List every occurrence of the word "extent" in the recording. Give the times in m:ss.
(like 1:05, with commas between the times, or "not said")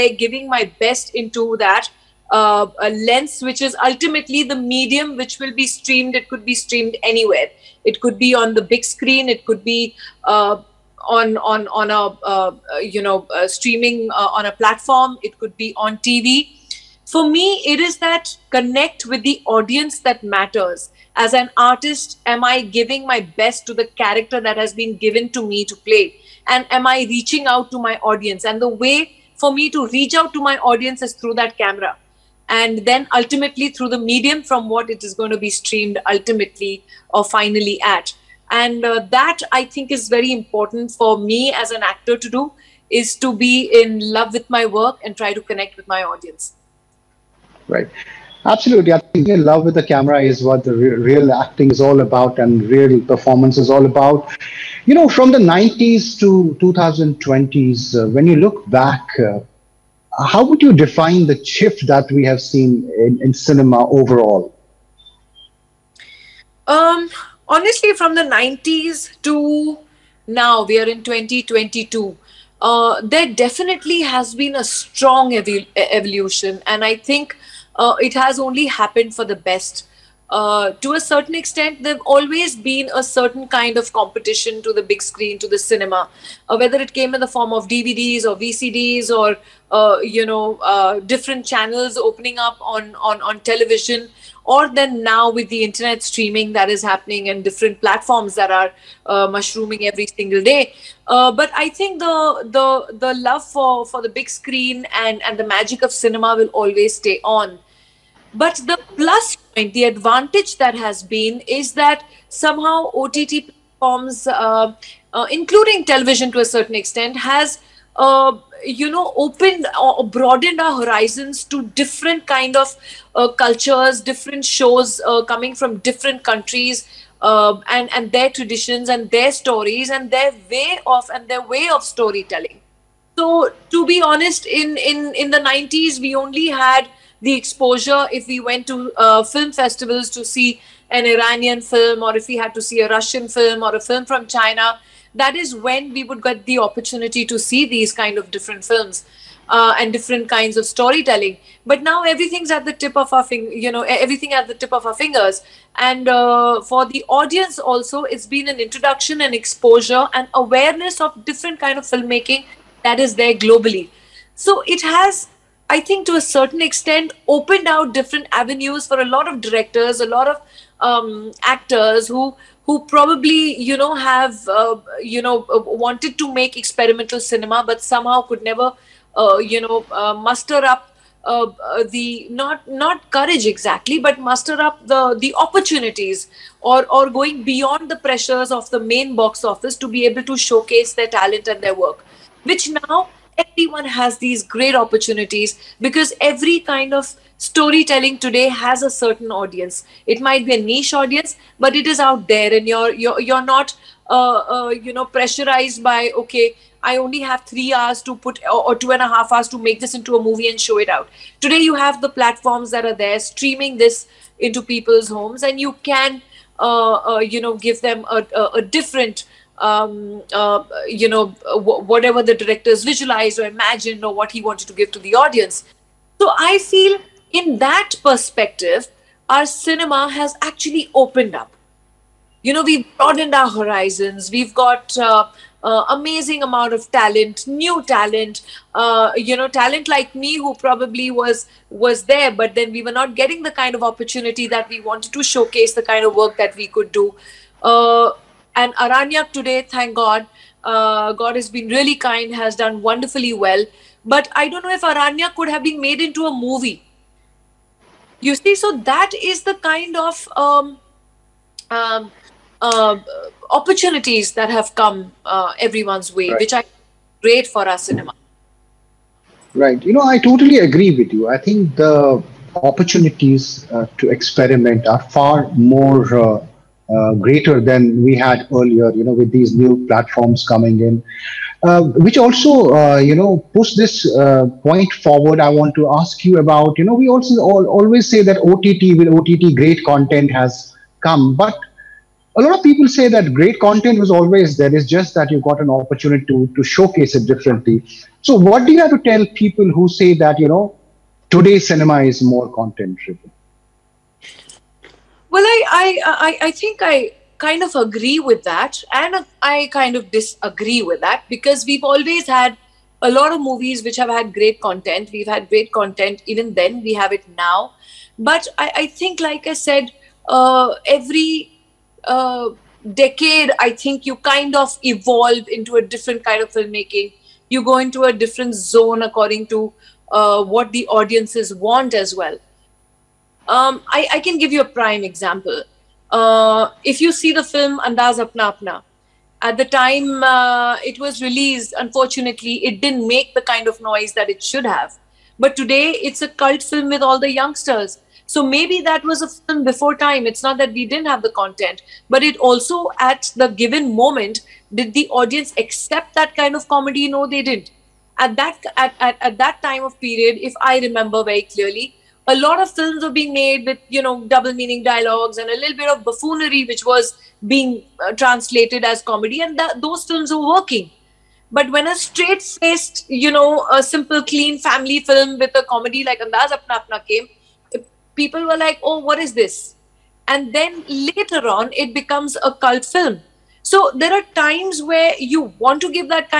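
1:21, 1:56, 2:46.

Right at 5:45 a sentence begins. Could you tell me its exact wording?
But today it's a cult film with all the youngsters.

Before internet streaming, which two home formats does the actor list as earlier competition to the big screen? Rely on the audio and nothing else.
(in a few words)
DVDs or VCDs.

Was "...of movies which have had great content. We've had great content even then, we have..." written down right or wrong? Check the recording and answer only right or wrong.
right.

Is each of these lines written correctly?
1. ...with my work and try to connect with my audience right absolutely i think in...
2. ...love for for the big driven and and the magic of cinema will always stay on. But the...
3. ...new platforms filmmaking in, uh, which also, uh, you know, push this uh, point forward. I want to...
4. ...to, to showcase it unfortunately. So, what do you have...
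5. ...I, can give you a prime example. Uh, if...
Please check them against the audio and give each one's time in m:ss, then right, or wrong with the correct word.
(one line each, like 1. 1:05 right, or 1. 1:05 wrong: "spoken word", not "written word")
1. 0:44 right
2. 1:43 wrong: "screen", not "driven"
3. 4:39 wrong: "coming", not "filmmaking"
4. 4:56 wrong: "differently", not "unfortunately"
5. 5:34 right.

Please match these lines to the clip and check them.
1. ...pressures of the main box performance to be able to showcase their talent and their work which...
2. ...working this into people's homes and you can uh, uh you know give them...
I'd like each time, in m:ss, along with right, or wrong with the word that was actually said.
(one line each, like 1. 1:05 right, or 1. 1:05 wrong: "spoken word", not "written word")
1. 3:08 wrong: "office", not "performance"
2. 3:33 wrong: "streaming", not "working".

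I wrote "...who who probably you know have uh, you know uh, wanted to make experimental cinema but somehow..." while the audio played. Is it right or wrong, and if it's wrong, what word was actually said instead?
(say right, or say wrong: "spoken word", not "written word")
right.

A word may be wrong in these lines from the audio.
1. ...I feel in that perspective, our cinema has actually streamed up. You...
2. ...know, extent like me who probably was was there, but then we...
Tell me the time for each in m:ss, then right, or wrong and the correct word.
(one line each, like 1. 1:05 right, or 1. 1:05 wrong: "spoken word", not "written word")
1. 3:46 wrong: "opened", not "streamed"
2. 3:59 wrong: "talent", not "extent".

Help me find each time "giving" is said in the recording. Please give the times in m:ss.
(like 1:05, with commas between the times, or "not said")
0:00, 0:22.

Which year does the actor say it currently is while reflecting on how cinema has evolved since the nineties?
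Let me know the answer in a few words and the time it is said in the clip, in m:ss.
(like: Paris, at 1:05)
2022, at 1:11.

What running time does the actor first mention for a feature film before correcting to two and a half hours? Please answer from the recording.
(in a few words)
3 hours.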